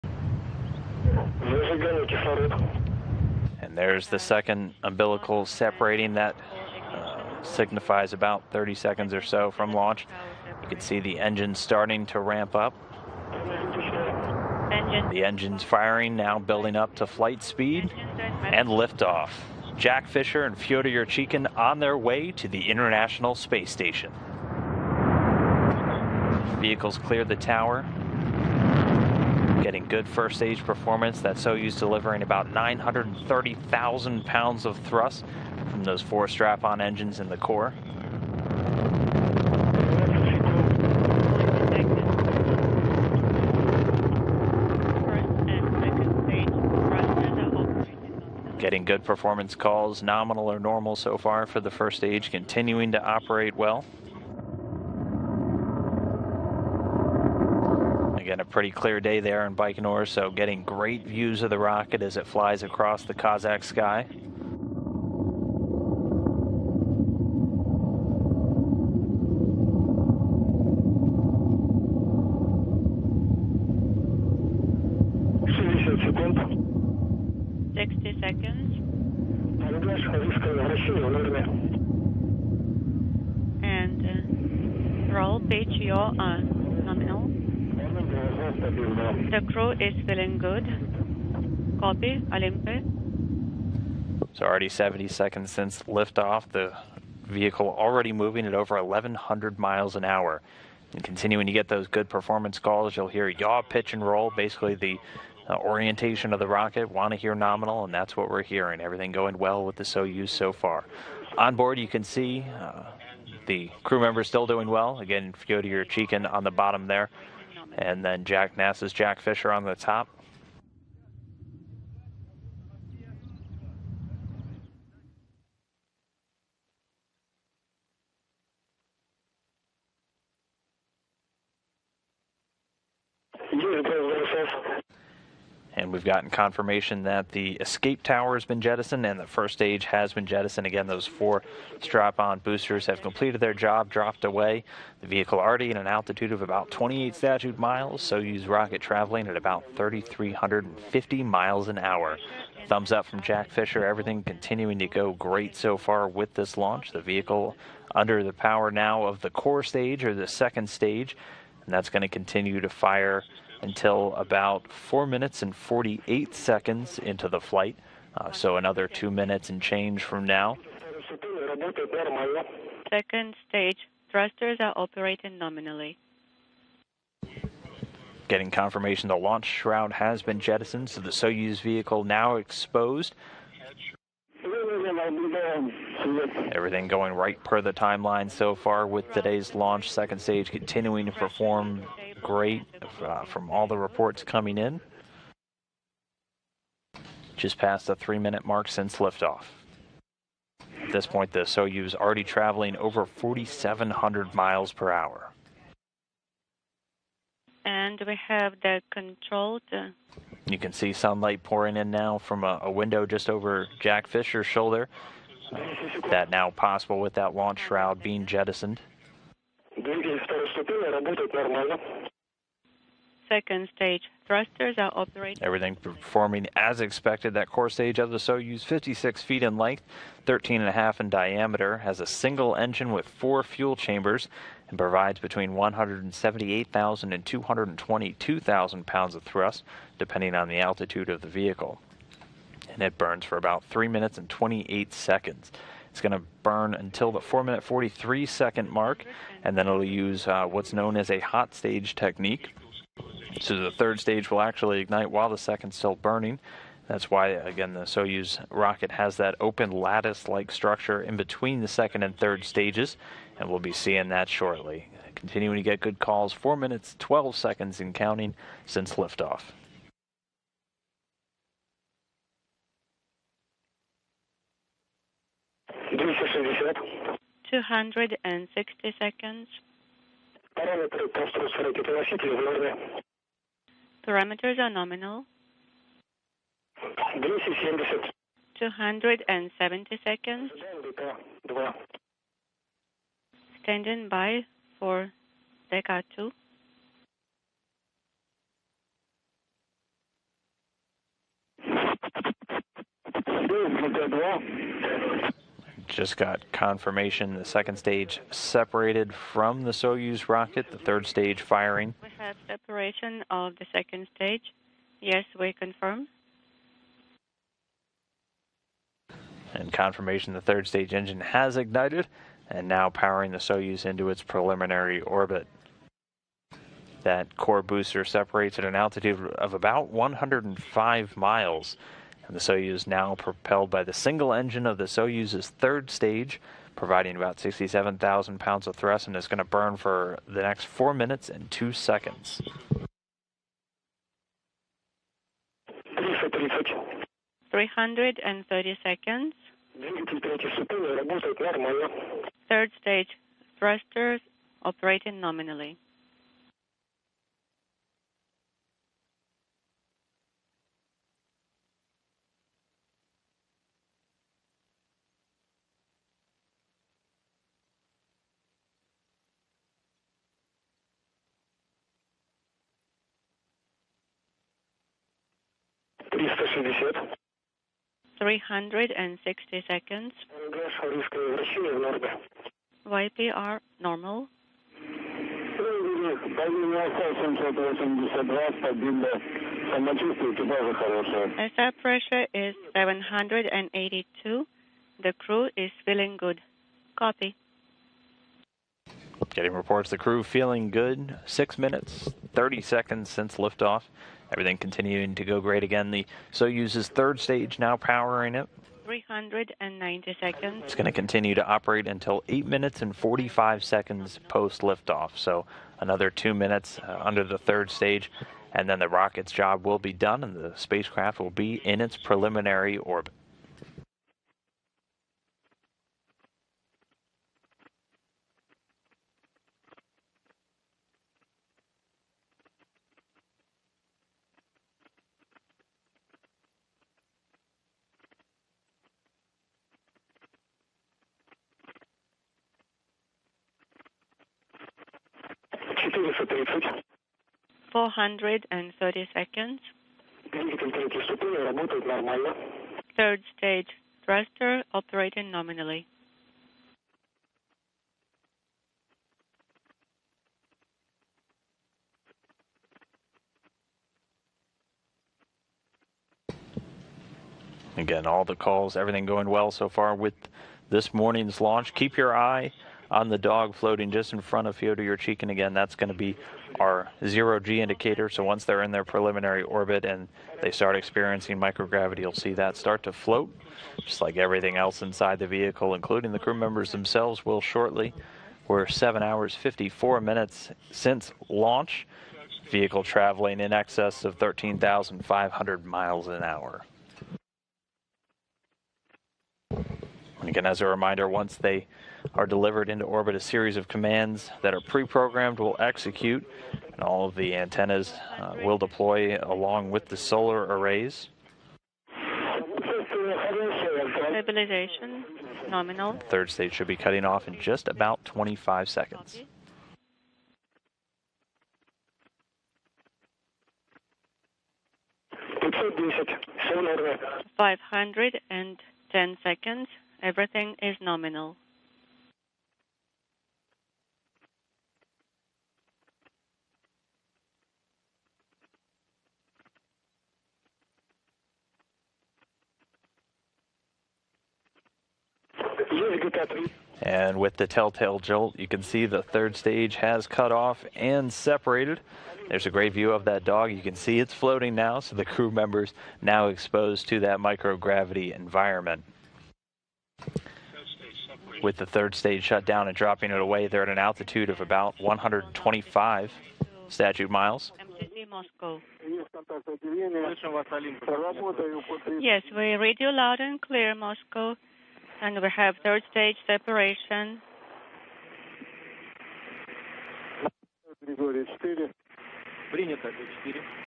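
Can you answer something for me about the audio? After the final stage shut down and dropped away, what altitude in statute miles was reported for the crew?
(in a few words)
125 statute miles.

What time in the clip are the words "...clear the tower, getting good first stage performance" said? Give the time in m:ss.
0:26.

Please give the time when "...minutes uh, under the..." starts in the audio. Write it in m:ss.
6:56.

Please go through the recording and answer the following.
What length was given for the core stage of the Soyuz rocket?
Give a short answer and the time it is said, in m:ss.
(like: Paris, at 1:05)
56 feet, at 3:48.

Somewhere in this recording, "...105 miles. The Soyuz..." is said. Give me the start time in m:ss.
5:29.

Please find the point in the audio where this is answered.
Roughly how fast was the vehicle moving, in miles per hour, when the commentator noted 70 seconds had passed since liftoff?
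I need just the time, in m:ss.
1:38.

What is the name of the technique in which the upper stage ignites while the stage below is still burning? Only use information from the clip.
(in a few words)
hot stage.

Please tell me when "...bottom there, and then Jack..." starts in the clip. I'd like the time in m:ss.
1:56.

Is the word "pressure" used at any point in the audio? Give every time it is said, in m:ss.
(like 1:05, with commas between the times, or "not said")
6:31.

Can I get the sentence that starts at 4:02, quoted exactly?
And it burns for about 3 minutes and 28 seconds.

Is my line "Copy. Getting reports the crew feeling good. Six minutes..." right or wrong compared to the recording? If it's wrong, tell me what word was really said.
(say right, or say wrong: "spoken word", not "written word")
right.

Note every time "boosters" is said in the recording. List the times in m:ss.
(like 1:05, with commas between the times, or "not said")
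2:22, 5:27.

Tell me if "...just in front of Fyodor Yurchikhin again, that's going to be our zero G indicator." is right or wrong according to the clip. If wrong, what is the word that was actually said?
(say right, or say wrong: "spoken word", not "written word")
right.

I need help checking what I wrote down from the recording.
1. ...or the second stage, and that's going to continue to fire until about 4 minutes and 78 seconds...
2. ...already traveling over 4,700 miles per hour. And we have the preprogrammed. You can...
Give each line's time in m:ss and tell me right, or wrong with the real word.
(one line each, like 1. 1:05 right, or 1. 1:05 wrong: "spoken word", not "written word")
1. 2:40 wrong: "48", not "78"
2. 3:21 wrong: "controlled", not "preprogrammed".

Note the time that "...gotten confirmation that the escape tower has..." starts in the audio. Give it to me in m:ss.
2:16.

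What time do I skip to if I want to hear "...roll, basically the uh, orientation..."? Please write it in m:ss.
1:44.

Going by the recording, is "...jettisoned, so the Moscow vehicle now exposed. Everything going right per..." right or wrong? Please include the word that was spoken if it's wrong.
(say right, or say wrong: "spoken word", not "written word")
wrong: "Soyuz", not "Moscow".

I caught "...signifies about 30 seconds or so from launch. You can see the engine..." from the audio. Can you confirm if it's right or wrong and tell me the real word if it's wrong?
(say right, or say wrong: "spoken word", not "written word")
right.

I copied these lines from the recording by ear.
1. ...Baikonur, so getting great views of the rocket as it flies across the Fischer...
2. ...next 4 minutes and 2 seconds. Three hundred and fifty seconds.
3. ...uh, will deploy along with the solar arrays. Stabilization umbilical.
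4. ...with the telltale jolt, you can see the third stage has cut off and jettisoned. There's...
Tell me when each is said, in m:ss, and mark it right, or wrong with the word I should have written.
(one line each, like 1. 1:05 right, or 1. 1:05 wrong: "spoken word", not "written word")
1. 0:59 wrong: "Kazakh", not "Fischer"
2. 5:40 wrong: "thirty", not "fifty"
3. 8:28 wrong: "nominal", not "umbilical"
4. 9:07 wrong: "separated", not "jettisoned".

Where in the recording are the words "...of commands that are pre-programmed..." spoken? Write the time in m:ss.
8:23.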